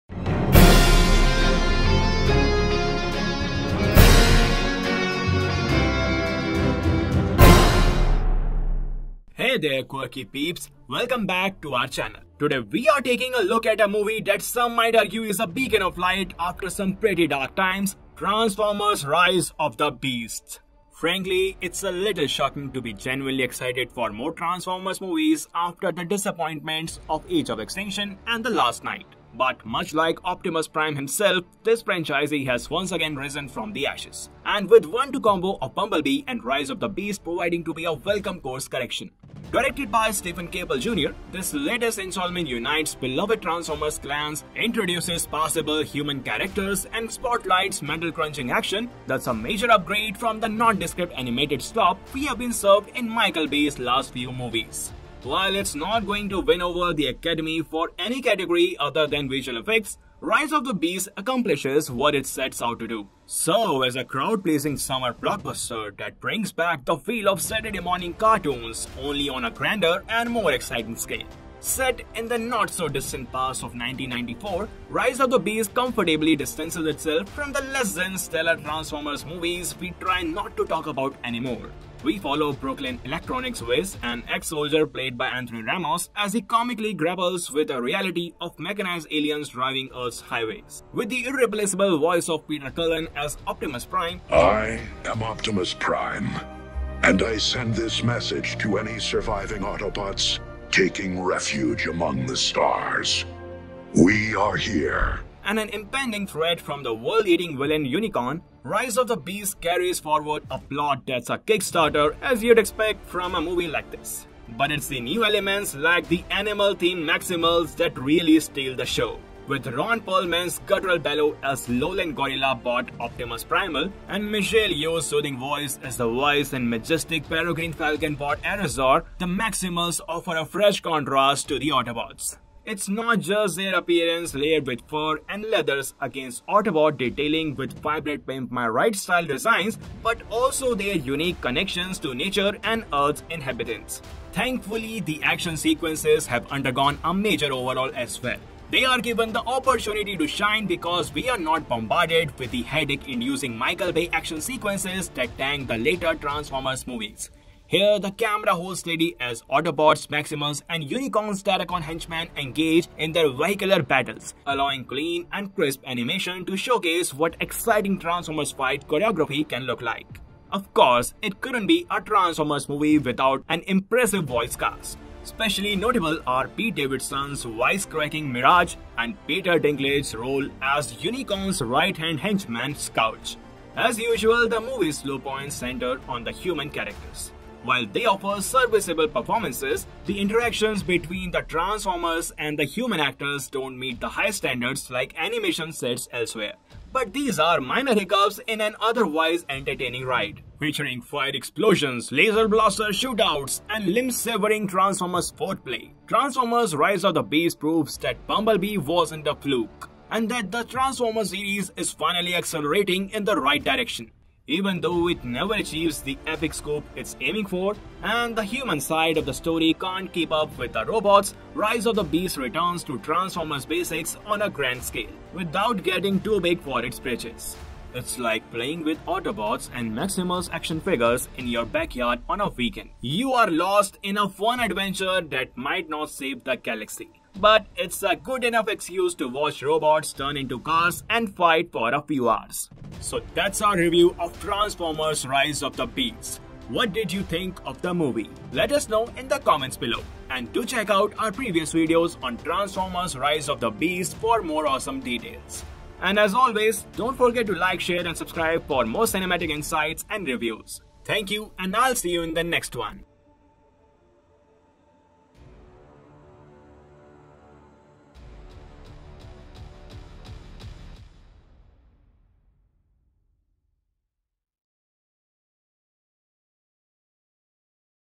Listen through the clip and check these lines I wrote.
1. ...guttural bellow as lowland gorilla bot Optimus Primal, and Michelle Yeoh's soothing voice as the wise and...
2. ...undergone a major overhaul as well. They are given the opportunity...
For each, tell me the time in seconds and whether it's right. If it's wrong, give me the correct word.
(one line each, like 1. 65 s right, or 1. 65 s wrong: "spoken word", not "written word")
1. 120 s right
2. 146 s right.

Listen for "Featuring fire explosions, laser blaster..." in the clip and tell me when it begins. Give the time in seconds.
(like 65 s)
200 s.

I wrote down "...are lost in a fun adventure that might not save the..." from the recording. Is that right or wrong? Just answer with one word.
right.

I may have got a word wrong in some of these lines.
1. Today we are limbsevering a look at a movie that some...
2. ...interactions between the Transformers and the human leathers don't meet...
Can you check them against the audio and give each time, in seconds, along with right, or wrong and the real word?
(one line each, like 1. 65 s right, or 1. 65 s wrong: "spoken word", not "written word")
1. 12 s wrong: "taking", not "limbsevering"
2. 190 s wrong: "actors", not "leathers".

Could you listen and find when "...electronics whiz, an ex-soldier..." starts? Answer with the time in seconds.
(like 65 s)
83 s.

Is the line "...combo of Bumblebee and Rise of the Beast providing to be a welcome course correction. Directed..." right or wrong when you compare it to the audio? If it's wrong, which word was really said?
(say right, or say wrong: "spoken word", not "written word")
right.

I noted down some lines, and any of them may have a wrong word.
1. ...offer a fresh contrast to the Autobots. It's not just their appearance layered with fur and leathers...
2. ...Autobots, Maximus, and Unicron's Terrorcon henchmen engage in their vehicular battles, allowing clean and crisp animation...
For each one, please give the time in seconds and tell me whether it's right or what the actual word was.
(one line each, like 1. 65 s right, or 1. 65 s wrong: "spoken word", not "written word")
1. 130 s right
2. 159 s right.